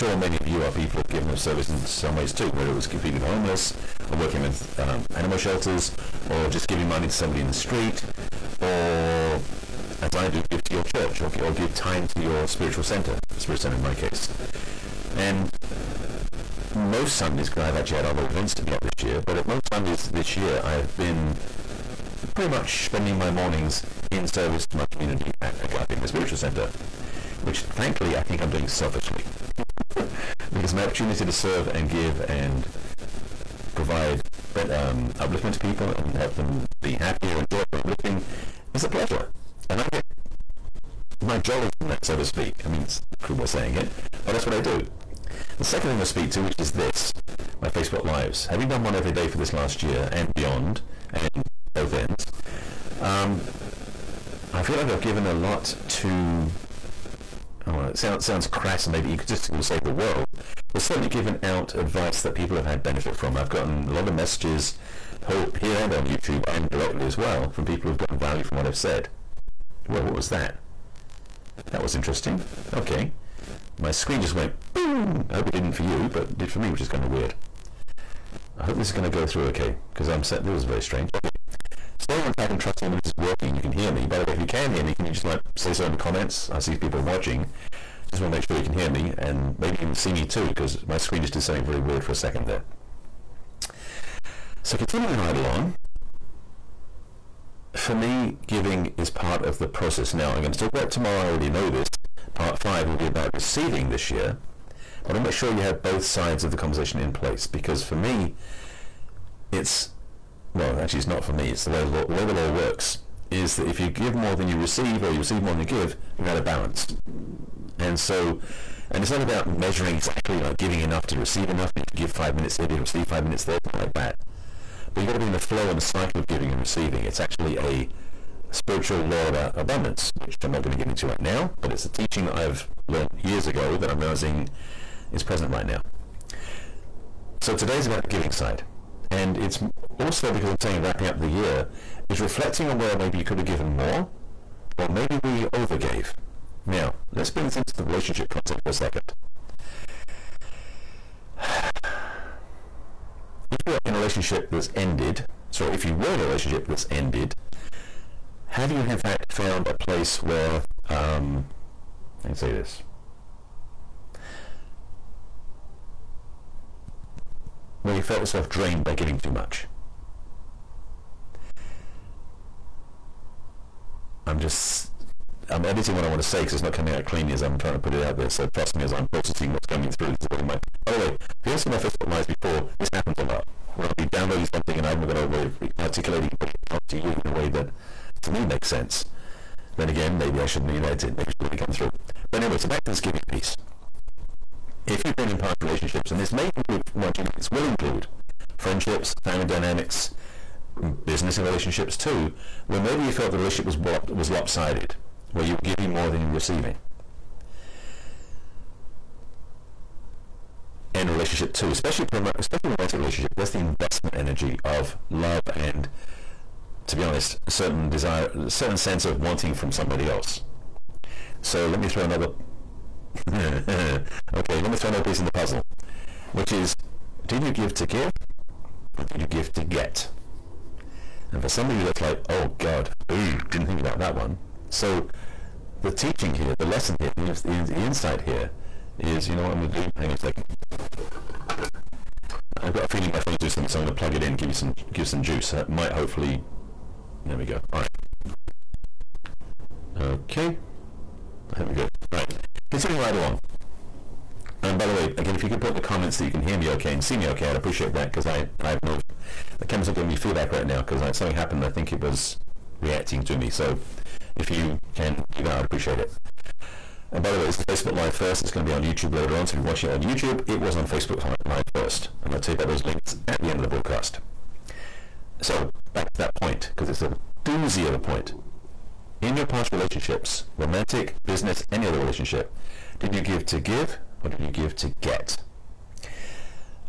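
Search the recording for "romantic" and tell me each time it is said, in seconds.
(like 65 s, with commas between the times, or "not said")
212 s, 280 s.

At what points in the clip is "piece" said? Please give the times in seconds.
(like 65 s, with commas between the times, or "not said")
193 s, 225 s.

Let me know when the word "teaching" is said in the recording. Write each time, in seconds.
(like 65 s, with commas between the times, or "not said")
131 s, 235 s.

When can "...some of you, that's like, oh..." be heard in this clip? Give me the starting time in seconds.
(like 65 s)
231 s.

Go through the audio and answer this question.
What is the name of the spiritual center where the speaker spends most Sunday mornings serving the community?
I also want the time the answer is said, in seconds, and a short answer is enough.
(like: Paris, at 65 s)
Agape, at 25 s.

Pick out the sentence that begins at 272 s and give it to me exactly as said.
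And I'll tell you about those links at the end of the broadcast.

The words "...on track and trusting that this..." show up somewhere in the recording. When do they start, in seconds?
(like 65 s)
82 s.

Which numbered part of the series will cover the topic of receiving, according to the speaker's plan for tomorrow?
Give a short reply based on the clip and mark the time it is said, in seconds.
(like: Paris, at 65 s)
Part 5, at 102 s.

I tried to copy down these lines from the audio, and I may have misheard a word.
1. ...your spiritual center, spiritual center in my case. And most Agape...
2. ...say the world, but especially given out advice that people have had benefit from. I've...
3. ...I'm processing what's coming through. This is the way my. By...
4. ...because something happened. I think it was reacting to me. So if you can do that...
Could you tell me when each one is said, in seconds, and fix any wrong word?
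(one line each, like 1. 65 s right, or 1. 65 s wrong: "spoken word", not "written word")
1. 12 s wrong: "Sundays", not "Agape"
2. 59 s wrong: "certainly", not "especially"
3. 178 s right
4. 260 s right.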